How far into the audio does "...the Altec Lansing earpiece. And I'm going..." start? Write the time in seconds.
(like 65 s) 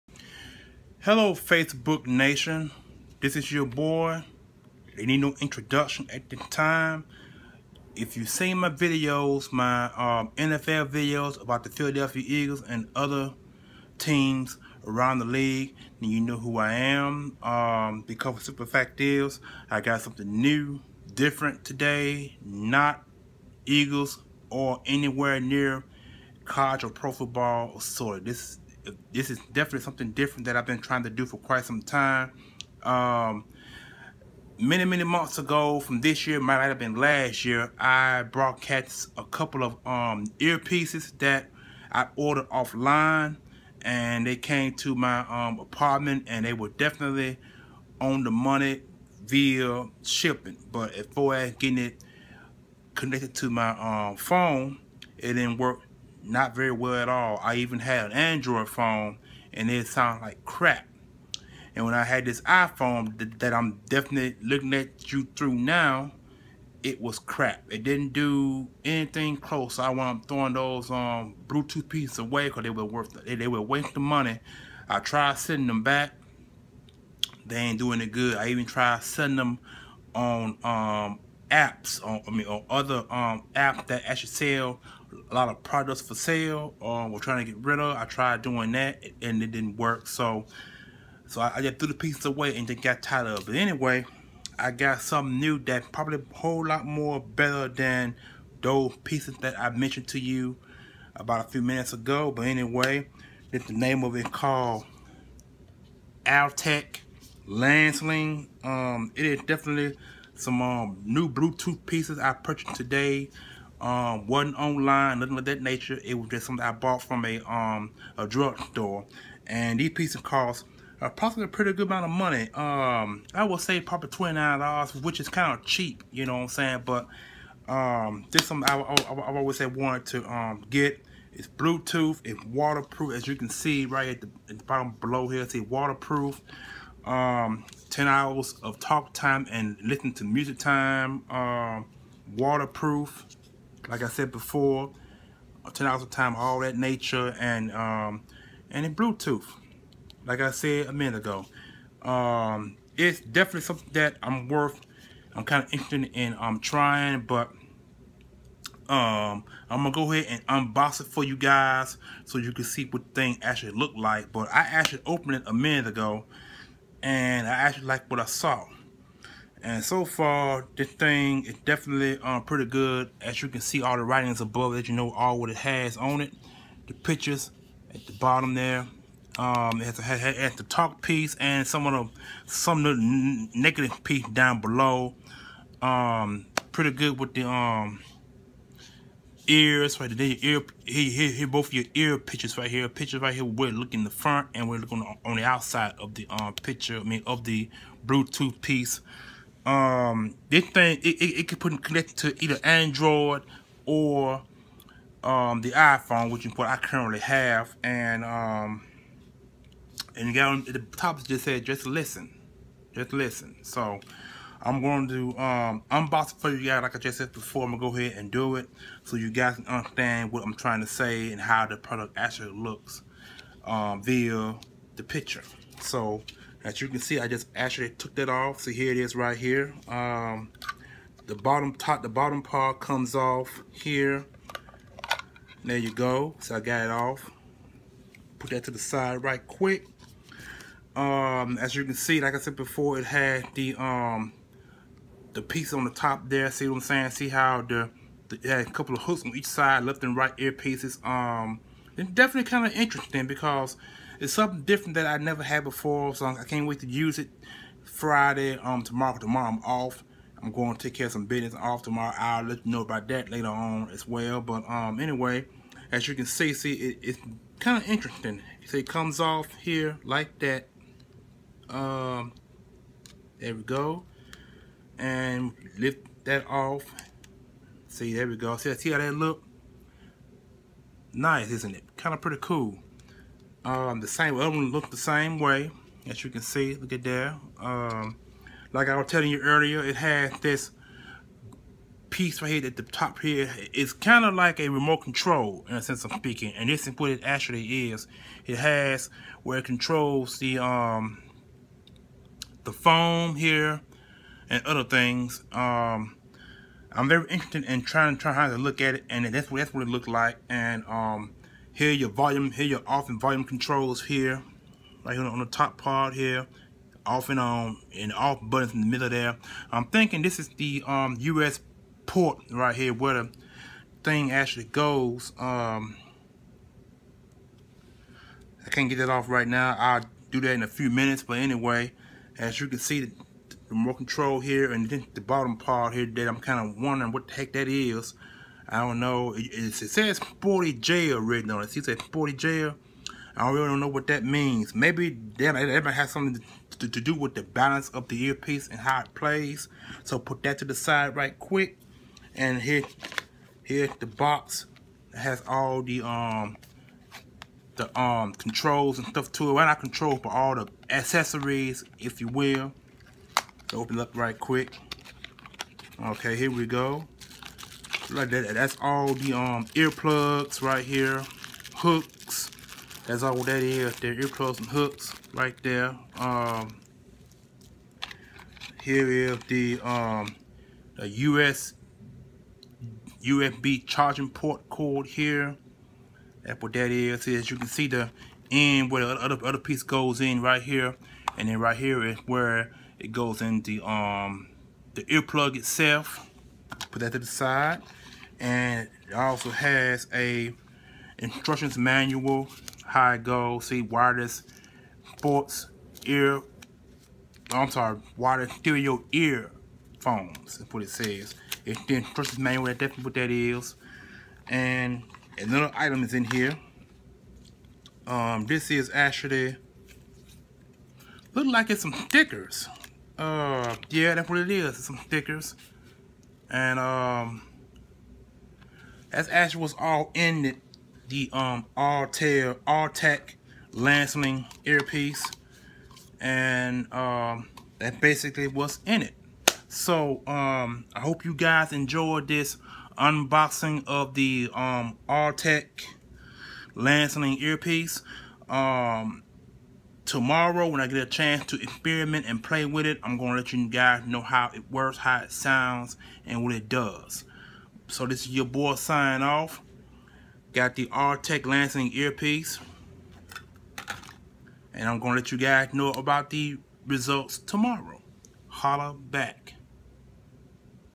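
460 s.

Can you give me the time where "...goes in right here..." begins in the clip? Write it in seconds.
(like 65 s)
389 s.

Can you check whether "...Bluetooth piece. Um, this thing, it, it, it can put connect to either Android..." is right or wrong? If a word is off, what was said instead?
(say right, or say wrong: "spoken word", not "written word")
right.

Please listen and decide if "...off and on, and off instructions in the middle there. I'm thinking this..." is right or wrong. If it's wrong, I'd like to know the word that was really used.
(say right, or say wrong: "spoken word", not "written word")
wrong: "buttons", not "instructions".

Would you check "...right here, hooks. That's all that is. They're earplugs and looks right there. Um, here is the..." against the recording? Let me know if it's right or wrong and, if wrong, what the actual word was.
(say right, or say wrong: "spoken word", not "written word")
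wrong: "hooks", not "looks".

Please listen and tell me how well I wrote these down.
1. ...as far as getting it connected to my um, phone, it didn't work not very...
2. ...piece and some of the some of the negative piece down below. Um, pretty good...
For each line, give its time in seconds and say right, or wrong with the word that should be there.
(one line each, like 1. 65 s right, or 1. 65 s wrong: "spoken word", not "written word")
1. 50 s right
2. 181 s right.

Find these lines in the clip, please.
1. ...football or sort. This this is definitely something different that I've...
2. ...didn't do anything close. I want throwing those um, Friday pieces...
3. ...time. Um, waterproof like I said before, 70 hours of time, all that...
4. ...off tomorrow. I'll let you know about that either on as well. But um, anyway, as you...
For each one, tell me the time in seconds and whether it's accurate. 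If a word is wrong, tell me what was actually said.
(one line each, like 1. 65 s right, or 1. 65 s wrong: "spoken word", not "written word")
1. 27 s right
2. 67 s wrong: "Bluetooth", not "Friday"
3. 140 s wrong: "10", not "70"
4. 261 s wrong: "later", not "either".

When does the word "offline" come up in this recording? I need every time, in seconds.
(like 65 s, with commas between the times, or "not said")
42 s.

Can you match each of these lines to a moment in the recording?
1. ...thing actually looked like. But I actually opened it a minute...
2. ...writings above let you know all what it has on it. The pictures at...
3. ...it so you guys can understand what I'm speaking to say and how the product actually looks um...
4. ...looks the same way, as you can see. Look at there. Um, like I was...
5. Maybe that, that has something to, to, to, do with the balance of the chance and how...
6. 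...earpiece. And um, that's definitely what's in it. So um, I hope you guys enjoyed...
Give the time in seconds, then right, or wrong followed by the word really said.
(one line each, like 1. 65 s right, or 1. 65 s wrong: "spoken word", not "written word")
1. 163 s right
2. 174 s right
3. 218 s wrong: "trying", not "speaking"
4. 284 s right
5. 344 s wrong: "earpiece", not "chance"
6. 434 s wrong: "basically", not "definitely".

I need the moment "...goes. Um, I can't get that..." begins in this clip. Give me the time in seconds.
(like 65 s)
324 s.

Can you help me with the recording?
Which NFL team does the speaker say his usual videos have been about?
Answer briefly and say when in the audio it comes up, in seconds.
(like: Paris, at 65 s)
Philadelphia Eagles, at 11 s.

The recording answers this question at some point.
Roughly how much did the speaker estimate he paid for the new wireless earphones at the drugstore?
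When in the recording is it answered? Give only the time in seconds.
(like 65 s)
124 s.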